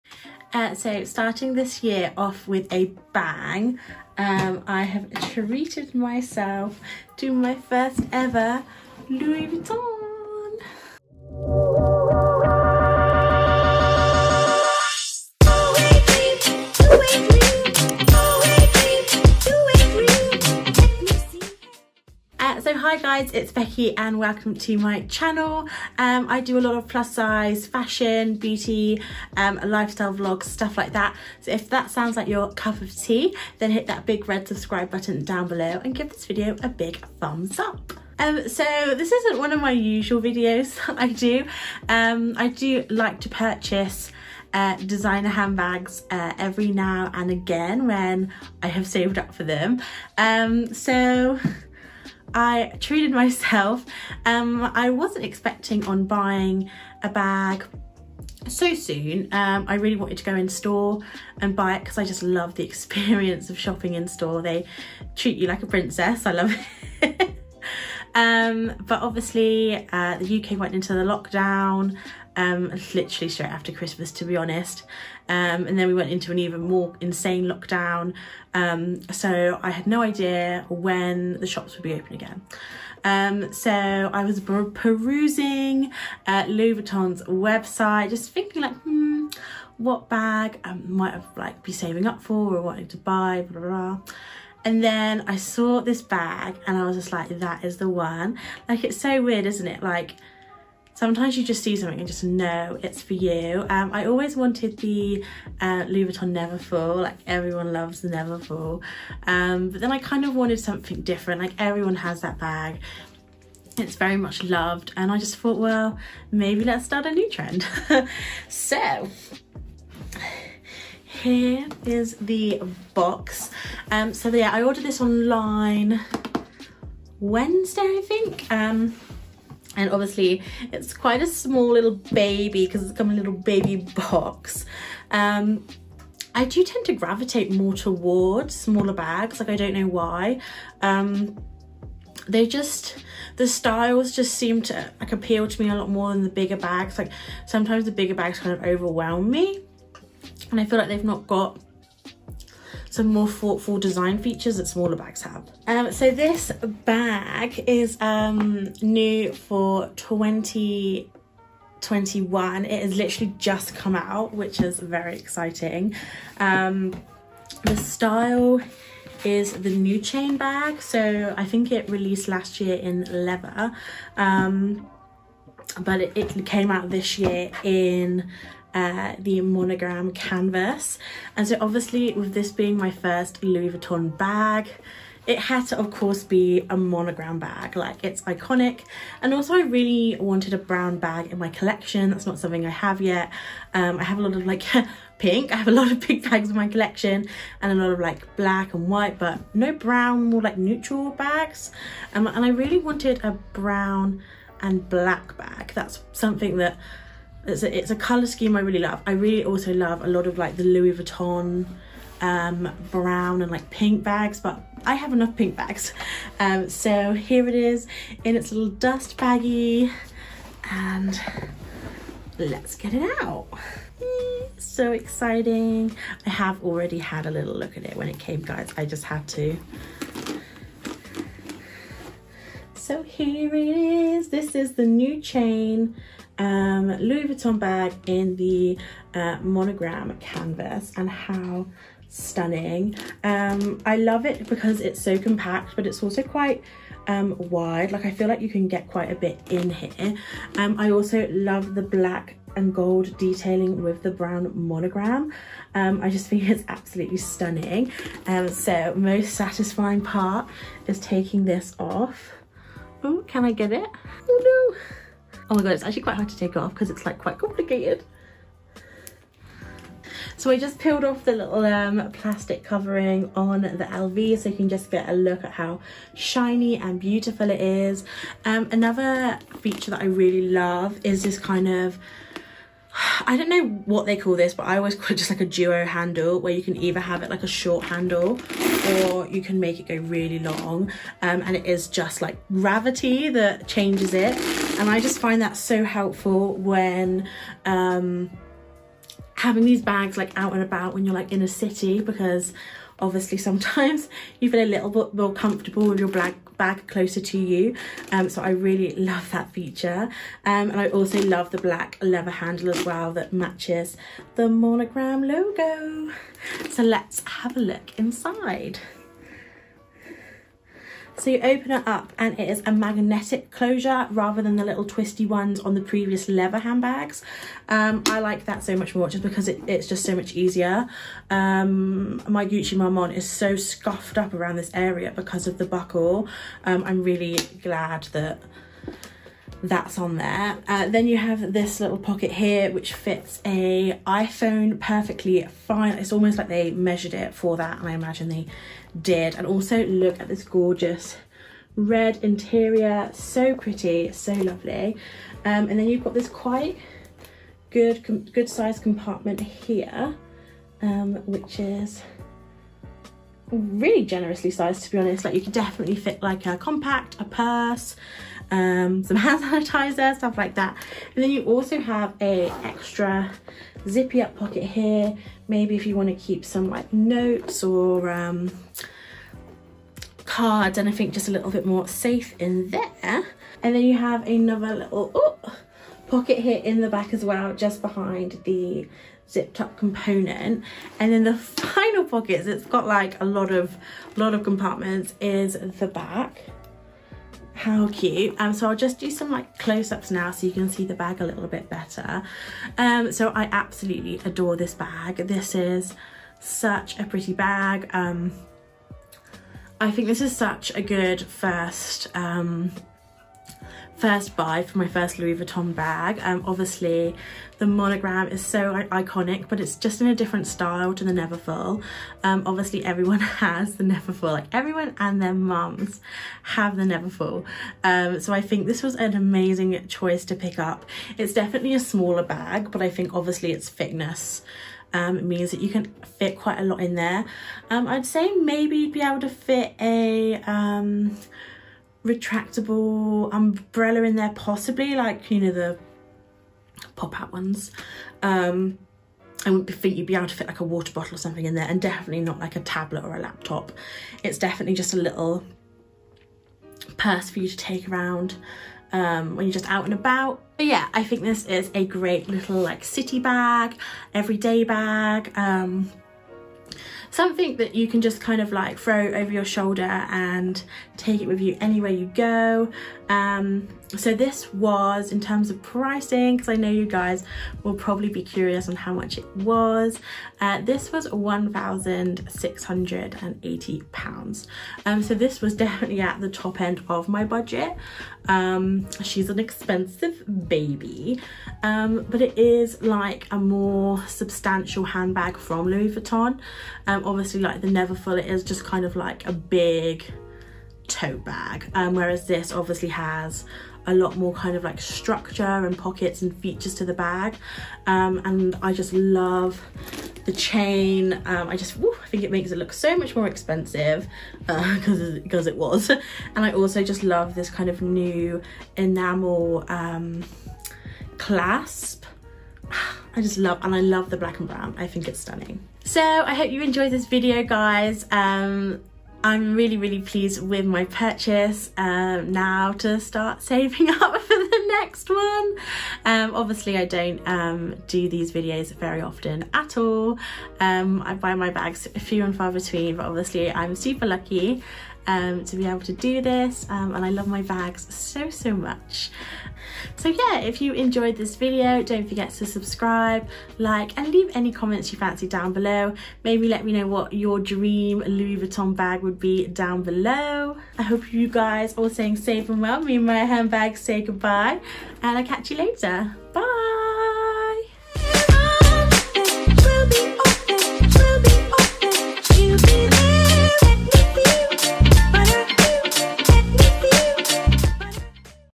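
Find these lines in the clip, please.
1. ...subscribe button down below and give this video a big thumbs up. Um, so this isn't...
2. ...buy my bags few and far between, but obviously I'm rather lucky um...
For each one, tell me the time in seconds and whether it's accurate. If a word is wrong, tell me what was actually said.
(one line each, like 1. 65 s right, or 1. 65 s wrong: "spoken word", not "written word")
1. 34 s right
2. 541 s wrong: "super", not "rather".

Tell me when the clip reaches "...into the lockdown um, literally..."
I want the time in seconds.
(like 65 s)
70 s.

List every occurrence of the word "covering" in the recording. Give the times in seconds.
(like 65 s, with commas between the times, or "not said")
272 s.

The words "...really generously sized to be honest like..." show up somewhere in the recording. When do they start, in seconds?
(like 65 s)
363 s.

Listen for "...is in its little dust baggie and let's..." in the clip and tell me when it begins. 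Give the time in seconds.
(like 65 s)
217 s.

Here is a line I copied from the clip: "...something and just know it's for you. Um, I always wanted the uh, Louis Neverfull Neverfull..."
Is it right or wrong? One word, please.
wrong.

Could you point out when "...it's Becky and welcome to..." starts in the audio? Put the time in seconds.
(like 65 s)
23 s.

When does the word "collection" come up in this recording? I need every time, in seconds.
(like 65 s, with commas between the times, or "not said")
191 s, 196 s.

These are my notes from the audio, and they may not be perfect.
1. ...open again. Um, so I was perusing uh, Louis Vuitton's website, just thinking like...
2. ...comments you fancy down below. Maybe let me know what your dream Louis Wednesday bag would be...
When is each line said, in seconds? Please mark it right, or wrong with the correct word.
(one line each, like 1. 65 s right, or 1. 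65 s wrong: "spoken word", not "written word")
1. 81 s right
2. 554 s wrong: "Vuitton", not "Wednesday".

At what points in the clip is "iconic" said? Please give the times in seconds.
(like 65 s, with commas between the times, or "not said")
188 s, 418 s.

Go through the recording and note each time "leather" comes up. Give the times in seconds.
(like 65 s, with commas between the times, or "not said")
173 s, 312 s, 326 s.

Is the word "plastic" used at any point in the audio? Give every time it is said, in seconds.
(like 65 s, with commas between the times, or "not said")
272 s.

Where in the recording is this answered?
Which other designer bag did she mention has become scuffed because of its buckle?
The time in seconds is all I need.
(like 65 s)
332 s.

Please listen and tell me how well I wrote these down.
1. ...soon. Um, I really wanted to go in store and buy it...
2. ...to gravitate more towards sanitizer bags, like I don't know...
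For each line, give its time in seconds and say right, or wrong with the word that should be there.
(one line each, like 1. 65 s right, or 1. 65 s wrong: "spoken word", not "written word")
1. 58 s right
2. 136 s wrong: "smaller", not "sanitizer".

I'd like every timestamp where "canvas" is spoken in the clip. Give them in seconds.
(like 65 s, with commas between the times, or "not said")
180 s, 240 s.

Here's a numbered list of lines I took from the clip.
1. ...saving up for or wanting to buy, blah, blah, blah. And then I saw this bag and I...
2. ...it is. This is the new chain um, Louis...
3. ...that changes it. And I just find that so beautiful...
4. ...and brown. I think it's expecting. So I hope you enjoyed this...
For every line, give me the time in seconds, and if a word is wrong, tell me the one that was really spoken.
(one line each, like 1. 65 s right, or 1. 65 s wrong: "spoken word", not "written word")
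1. 91 s right
2. 233 s right
3. 293 s wrong: "helpful", not "beautiful"
4. 524 s wrong: "stunning", not "expecting".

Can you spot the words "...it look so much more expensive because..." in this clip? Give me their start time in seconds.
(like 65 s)
512 s.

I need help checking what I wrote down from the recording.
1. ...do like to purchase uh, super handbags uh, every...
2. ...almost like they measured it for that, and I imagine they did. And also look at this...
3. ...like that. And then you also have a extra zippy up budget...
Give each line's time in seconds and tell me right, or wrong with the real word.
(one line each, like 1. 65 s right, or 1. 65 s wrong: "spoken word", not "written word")
1. 42 s wrong: "designer", not "super"
2. 346 s right
3. 370 s wrong: "pocket", not "budget".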